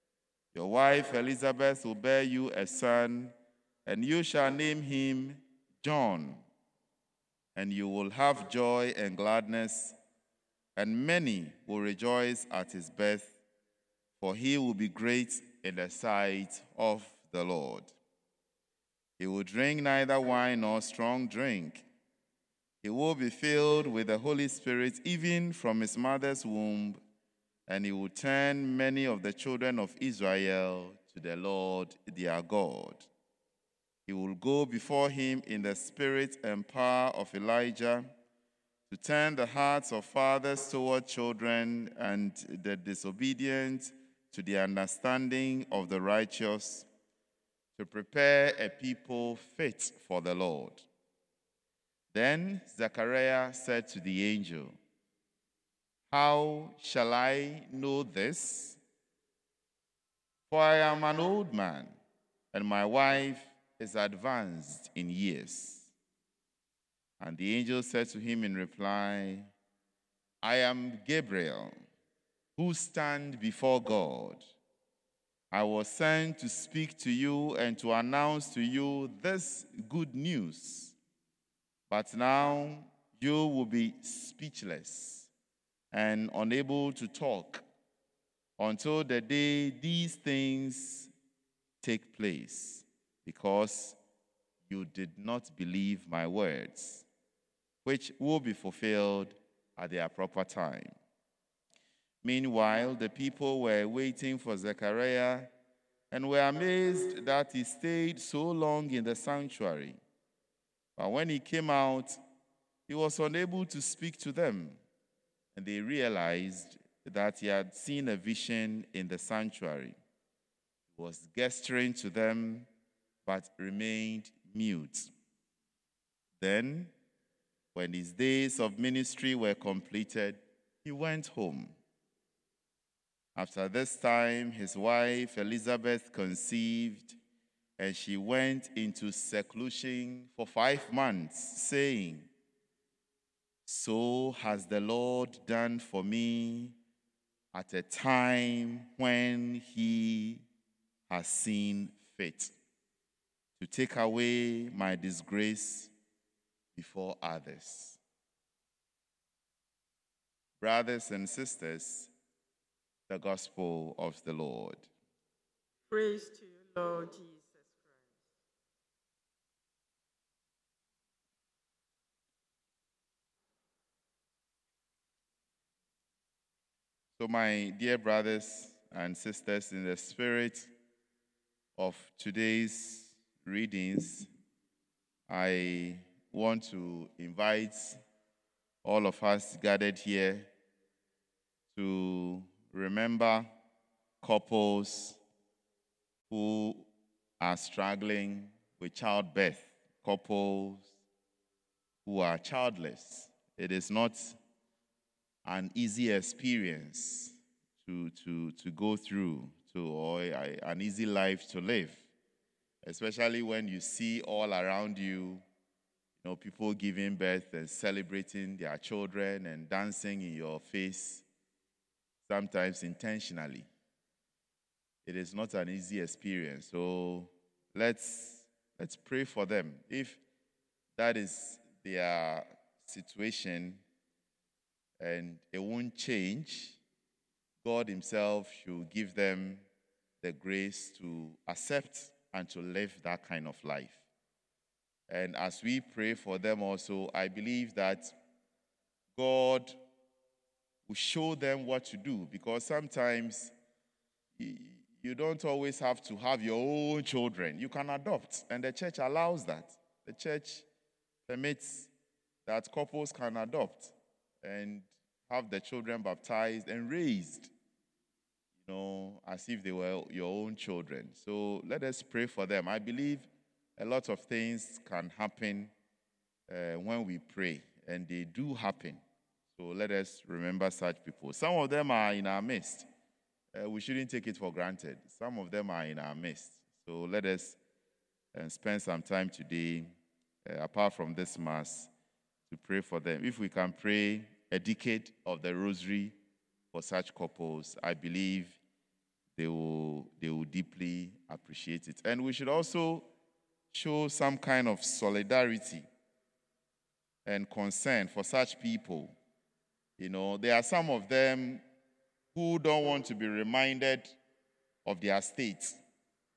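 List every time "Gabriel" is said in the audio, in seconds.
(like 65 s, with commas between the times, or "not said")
71 s.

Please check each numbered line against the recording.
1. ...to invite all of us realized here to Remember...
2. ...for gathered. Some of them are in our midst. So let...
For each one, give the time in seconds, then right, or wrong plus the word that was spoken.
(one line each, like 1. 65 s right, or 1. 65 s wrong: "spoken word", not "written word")
1. 186 s wrong: "gathered", not "realized"
2. 284 s wrong: "granted", not "gathered".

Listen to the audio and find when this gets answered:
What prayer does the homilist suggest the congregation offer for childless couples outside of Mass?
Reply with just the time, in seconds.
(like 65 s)
294 s.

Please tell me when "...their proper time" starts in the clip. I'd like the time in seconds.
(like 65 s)
99 s.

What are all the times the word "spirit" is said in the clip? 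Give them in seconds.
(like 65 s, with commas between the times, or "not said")
24 s, 35 s, 179 s.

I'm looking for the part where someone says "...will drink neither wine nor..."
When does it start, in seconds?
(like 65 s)
19 s.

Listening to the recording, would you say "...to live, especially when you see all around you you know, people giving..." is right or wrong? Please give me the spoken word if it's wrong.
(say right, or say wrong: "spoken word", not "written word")
right.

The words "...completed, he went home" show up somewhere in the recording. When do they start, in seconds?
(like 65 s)
129 s.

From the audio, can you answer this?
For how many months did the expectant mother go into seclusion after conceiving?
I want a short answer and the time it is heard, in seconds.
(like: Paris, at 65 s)
5, at 140 s.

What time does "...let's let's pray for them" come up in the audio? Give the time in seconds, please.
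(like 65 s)
227 s.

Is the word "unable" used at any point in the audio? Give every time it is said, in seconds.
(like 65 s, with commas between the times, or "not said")
86 s, 113 s.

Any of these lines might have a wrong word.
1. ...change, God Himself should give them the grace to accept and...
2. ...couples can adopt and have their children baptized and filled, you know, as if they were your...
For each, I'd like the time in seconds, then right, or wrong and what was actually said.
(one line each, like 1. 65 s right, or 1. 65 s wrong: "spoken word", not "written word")
1. 235 s right
2. 262 s wrong: "raised", not "filled".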